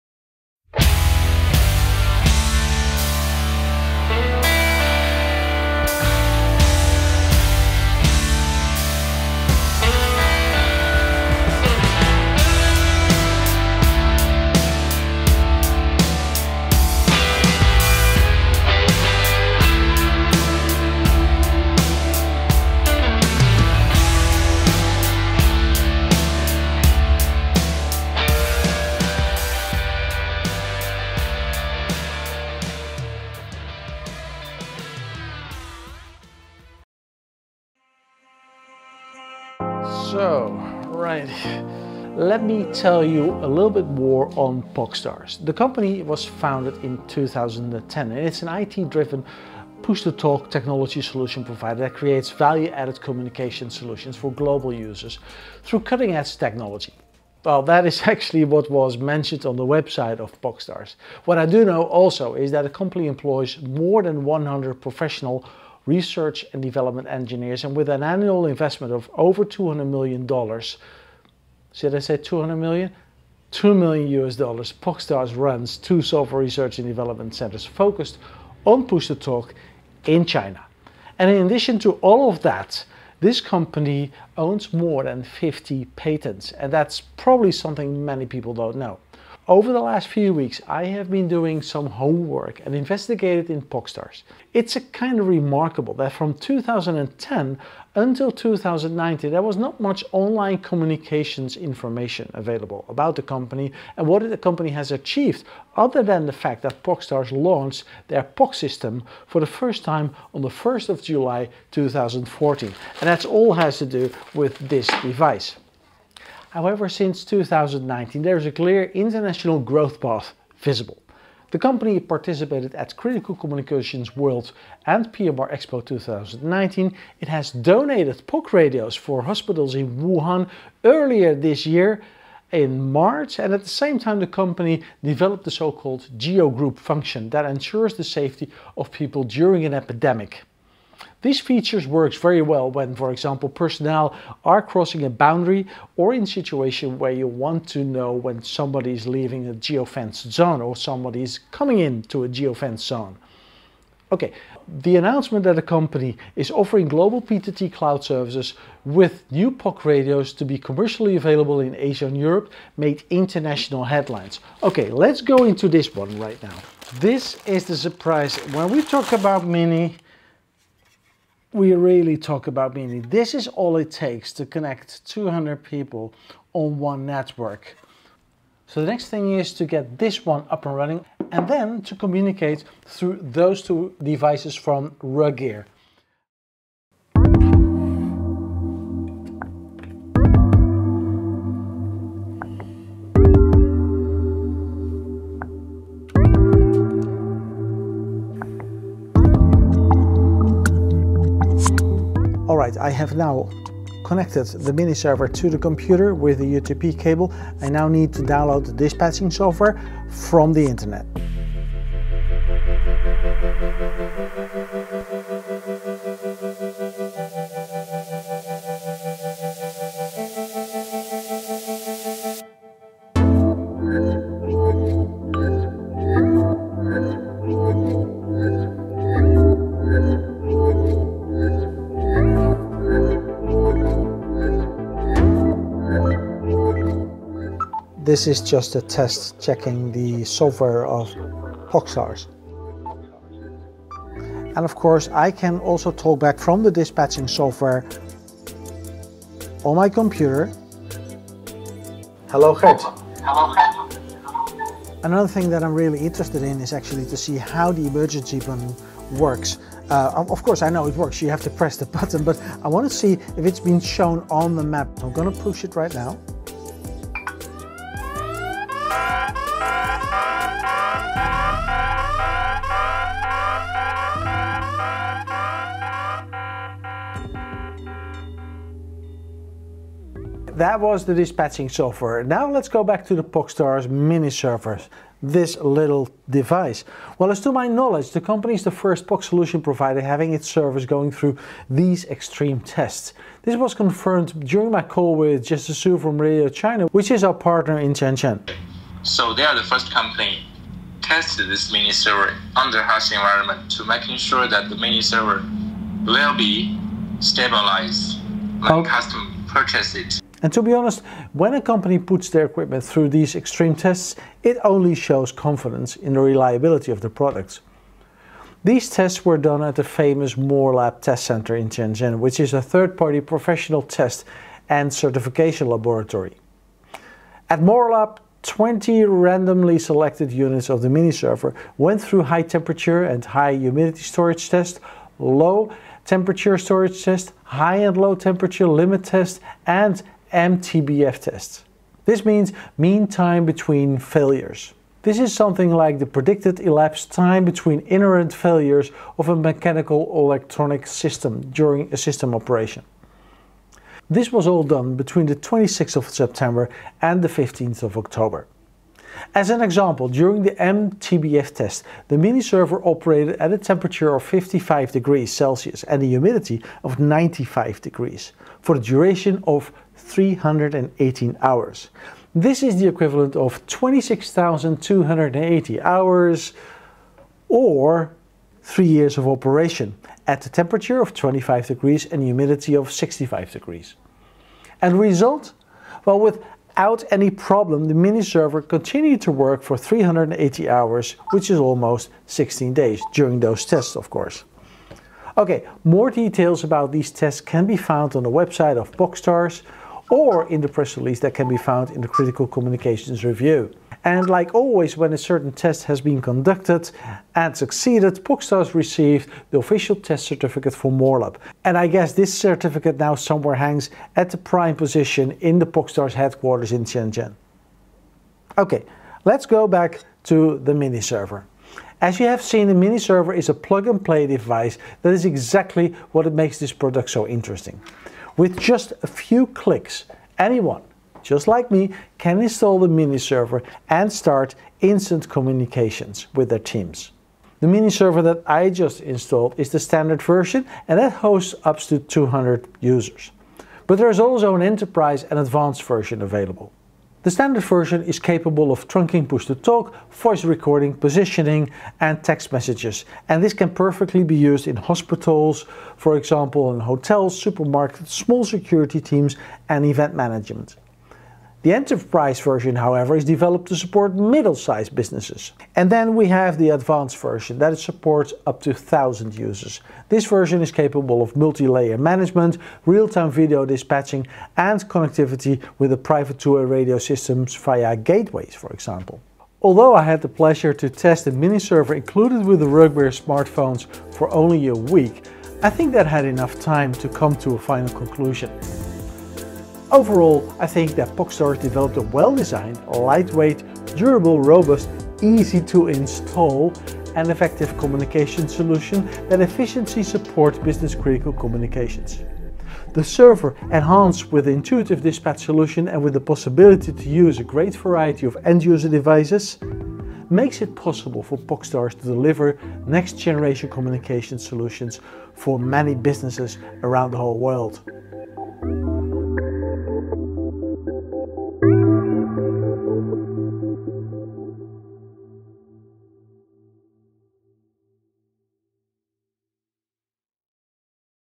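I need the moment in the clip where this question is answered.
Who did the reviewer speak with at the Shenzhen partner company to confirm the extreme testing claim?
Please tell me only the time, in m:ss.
4:55.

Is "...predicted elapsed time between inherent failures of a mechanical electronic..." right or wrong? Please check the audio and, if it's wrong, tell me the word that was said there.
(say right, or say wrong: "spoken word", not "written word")
right.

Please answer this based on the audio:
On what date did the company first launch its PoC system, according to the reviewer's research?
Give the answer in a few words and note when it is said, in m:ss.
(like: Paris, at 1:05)
1 July 2014, at 1:50.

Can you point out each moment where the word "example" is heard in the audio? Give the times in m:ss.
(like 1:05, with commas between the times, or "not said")
2:23, 5:59, 7:36, 7:58.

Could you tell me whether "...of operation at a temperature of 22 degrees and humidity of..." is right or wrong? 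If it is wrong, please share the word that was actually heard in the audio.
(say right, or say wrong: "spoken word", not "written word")
wrong: "25", not "22".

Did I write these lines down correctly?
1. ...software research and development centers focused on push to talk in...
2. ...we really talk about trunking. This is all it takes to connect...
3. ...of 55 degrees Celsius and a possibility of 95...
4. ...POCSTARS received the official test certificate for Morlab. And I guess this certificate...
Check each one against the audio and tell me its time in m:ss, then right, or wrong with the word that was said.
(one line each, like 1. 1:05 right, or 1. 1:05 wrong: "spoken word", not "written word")
1. 1:16 right
2. 2:51 wrong: "meaning", not "trunking"
3. 6:04 wrong: "humidity", not "possibility"
4. 6:48 right.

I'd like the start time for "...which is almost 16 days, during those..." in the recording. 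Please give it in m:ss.
6:31.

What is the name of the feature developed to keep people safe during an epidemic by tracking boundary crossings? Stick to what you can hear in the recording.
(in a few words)
GeoGroup.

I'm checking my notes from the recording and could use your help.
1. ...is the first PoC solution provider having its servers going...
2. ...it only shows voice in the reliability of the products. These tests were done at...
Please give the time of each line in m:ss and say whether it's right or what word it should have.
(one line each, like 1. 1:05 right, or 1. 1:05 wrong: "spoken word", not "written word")
1. 4:48 right
2. 5:14 wrong: "confidence", not "voice".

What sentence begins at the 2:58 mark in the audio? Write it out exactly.
So the next thing is to get this one up and running and then to communicate through those two devices from RugGear.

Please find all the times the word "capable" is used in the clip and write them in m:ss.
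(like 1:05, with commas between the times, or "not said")
7:28, 7:50.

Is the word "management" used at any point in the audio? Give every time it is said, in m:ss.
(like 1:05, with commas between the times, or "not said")
7:40, 7:51.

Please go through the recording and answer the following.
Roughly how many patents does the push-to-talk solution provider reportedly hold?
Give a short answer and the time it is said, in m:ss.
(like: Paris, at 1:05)
more than 50, at 1:24.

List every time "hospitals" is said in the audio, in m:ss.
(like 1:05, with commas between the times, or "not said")
2:09, 7:34.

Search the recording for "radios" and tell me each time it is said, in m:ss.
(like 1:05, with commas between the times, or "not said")
2:08, 2:39, 4:56, 7:56.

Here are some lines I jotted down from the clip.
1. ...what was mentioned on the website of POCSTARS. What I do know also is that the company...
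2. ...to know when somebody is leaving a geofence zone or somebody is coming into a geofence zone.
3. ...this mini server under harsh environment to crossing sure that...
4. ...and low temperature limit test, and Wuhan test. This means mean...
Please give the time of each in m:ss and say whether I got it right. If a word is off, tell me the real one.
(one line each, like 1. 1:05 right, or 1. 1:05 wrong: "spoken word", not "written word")
1. 0:58 right
2. 2:27 right
3. 5:01 wrong: "making", not "crossing"
4. 5:37 wrong: "MTBF", not "Wuhan".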